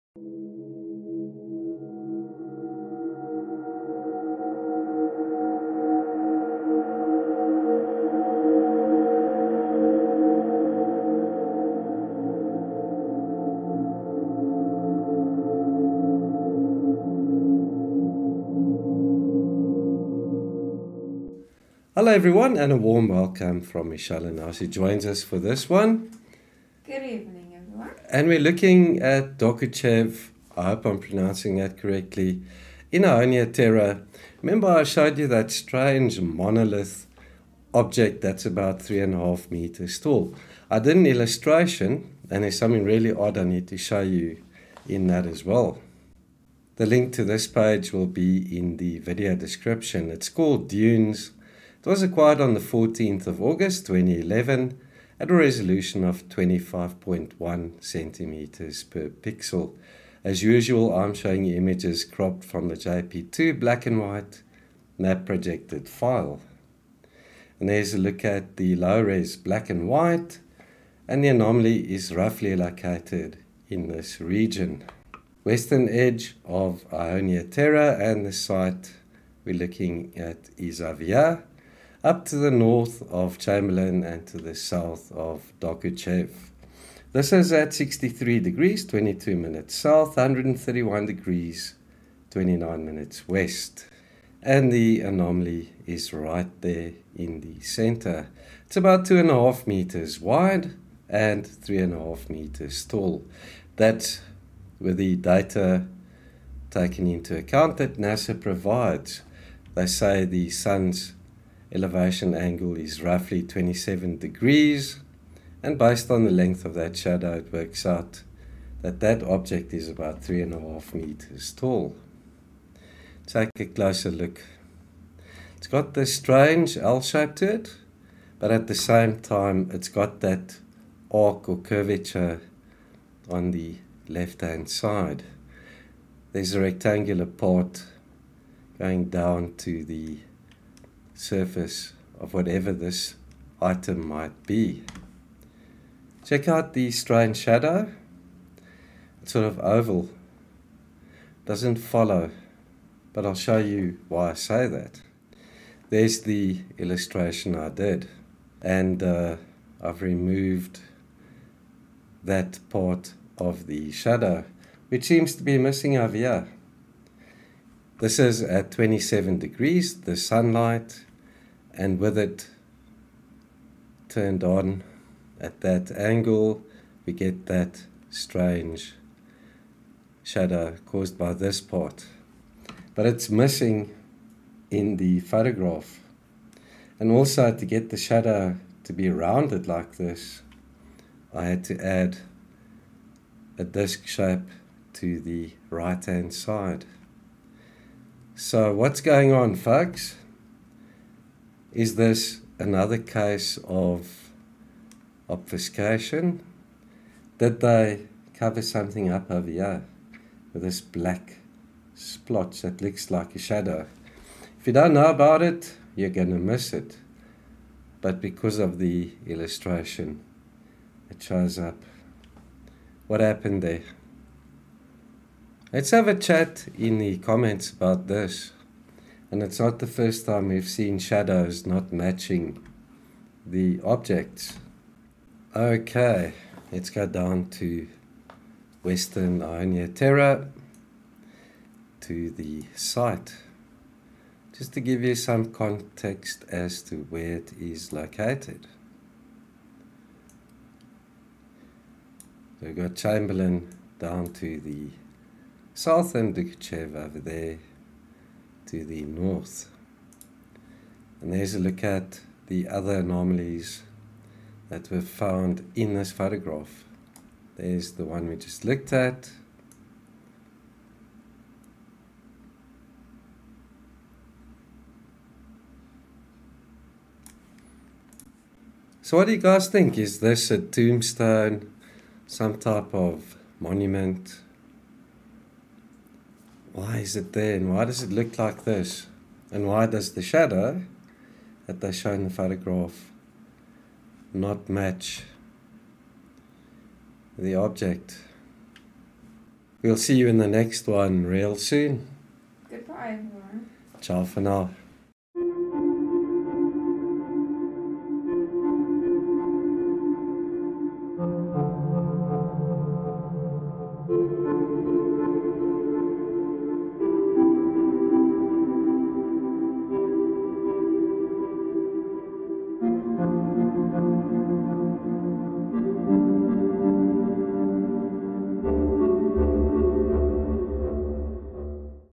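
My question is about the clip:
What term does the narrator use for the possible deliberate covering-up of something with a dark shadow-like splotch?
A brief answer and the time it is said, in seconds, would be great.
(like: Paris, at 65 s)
obfuscation, at 205 s.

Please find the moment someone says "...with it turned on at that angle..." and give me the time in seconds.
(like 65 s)
171 s.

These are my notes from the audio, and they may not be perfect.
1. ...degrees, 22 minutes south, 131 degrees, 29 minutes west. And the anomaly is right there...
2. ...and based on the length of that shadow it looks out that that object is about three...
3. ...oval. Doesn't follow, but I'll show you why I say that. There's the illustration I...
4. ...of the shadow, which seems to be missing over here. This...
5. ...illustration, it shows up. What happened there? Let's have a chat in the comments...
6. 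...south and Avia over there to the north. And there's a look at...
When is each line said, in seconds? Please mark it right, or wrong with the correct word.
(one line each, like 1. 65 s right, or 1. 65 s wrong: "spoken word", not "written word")
1. 88 s right
2. 115 s wrong: "works", not "looks"
3. 149 s right
4. 163 s right
5. 219 s right
6. 255 s wrong: "Dokuchaev", not "Avia".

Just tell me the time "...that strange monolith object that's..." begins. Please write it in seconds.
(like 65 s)
35 s.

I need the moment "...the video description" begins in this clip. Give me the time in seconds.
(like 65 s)
48 s.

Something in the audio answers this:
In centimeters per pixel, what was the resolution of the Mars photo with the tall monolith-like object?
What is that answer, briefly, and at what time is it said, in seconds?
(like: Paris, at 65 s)
25.1, at 56 s.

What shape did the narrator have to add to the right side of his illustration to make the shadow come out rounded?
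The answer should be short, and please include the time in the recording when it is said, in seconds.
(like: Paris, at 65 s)
disc, at 193 s.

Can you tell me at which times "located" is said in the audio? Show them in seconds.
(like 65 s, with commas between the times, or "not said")
72 s, 247 s.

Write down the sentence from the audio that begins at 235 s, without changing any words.
Okay, let's go down to Western Aonia Terra to the site.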